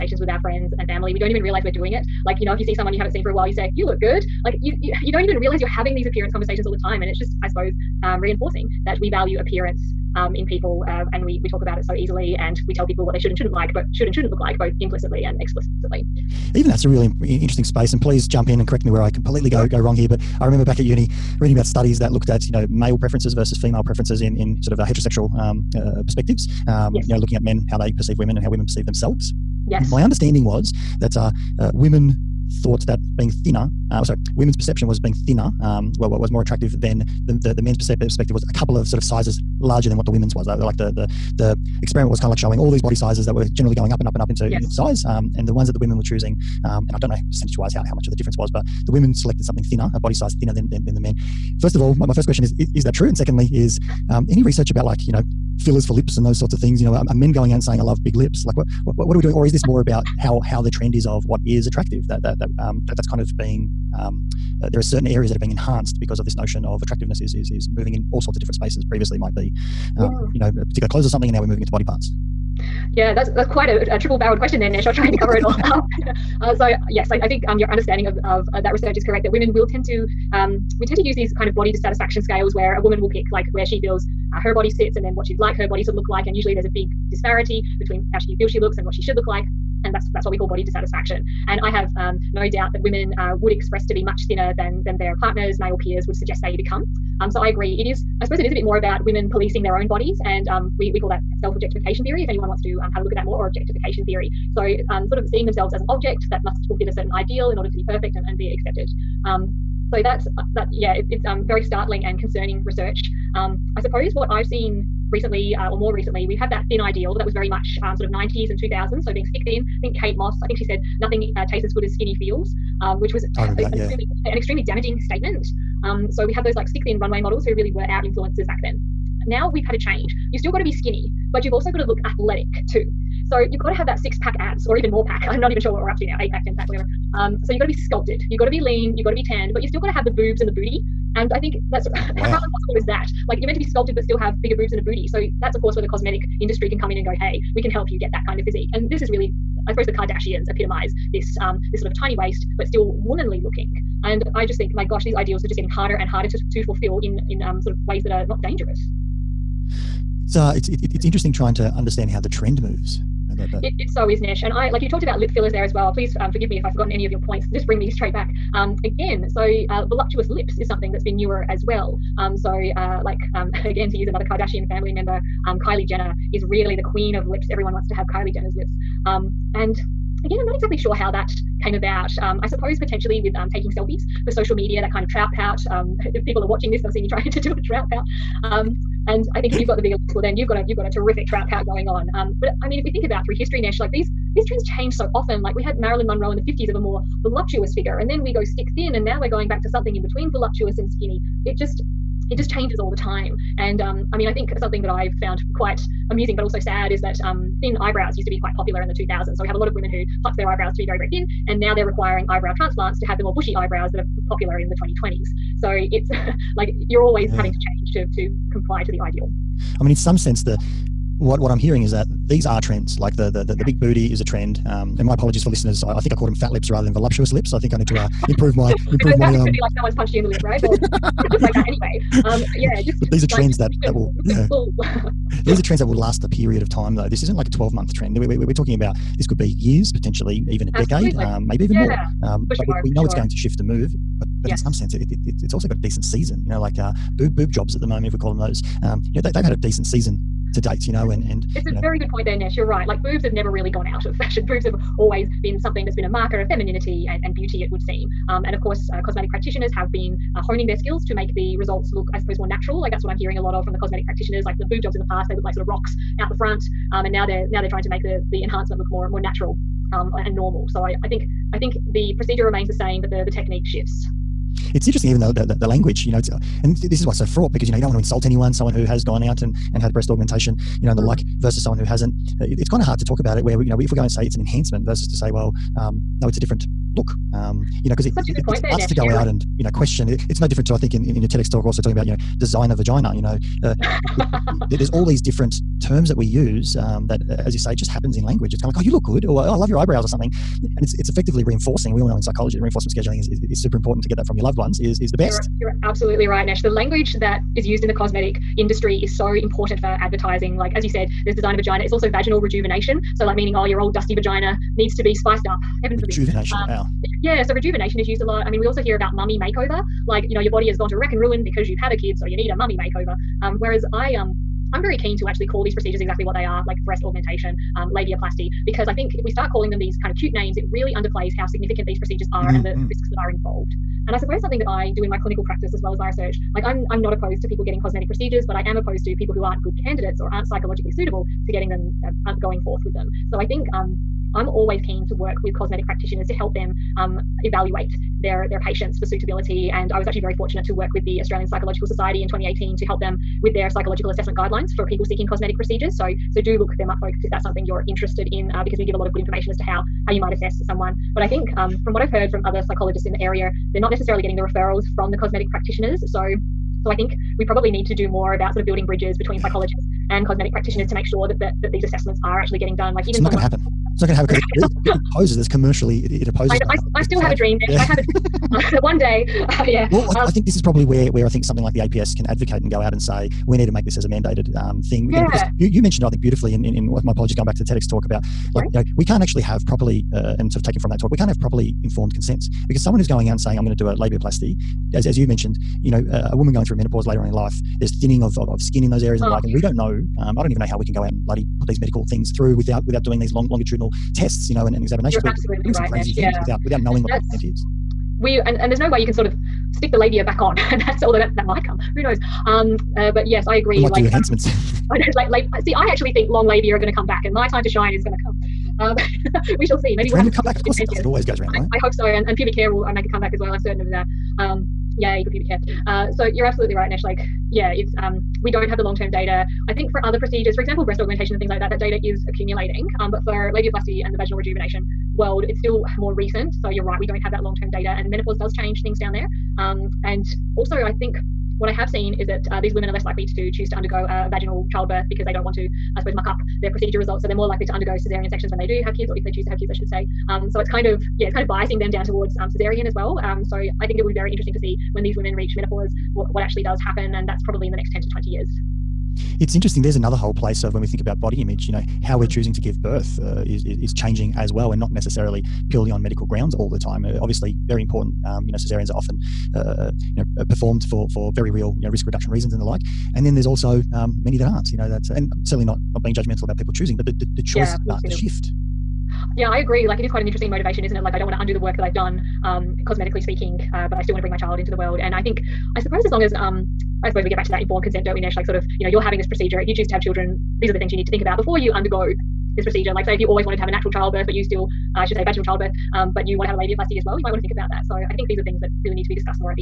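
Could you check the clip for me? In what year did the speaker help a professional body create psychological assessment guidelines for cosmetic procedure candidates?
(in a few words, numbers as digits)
2018.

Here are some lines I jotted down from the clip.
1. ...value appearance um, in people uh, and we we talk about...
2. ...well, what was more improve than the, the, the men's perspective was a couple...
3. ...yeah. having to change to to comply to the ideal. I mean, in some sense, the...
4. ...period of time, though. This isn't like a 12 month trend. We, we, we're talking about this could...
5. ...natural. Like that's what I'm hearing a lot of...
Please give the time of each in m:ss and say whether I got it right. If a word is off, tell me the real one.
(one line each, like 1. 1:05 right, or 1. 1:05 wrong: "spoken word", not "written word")
1. 0:09 right
2. 0:35 wrong: "attractive", not "improve"
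3. 3:37 right
4. 3:56 right
5. 4:22 right.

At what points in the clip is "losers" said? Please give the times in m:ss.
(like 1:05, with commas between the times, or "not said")
not said.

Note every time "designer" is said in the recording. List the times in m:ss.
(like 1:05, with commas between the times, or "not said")
4:52, 5:11.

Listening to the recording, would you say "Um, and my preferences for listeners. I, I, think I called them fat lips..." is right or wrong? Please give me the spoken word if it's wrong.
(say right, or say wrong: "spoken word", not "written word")
wrong: "apologies", not "preferences".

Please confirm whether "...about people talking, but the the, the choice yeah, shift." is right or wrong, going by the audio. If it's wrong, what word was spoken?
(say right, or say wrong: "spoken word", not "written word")
wrong: "choosing", not "talking".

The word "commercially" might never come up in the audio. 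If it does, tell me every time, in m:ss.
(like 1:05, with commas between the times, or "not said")
6:15.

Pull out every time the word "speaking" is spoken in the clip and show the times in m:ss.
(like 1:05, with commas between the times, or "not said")
8:03.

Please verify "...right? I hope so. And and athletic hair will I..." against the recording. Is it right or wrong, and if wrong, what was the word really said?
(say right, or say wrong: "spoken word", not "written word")
wrong: "pubic", not "athletic".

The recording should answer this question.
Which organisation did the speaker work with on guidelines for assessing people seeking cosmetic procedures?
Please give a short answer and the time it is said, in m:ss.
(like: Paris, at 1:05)
Australian Psychological Society, at 5:51.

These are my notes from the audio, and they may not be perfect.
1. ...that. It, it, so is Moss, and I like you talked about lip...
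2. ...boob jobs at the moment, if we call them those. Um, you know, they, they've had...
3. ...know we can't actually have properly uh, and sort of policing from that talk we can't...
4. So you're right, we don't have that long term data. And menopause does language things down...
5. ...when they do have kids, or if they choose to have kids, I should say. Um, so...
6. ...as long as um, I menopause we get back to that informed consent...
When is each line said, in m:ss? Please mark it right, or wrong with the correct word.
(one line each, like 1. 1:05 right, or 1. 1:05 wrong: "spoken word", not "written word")
1. 2:43 wrong: "Nesh", not "Moss"
2. 4:07 right
3. 6:28 wrong: "taking", not "policing"
4. 7:16 wrong: "change", not "language"
5. 7:28 right
6. 8:06 wrong: "suppose", not "menopause".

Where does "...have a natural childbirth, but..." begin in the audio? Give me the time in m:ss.
8:13.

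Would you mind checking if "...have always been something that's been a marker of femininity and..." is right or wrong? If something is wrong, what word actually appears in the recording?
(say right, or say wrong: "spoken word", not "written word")
right.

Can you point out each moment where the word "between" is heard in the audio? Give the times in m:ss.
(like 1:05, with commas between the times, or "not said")
1:27, 3:20, 6:09.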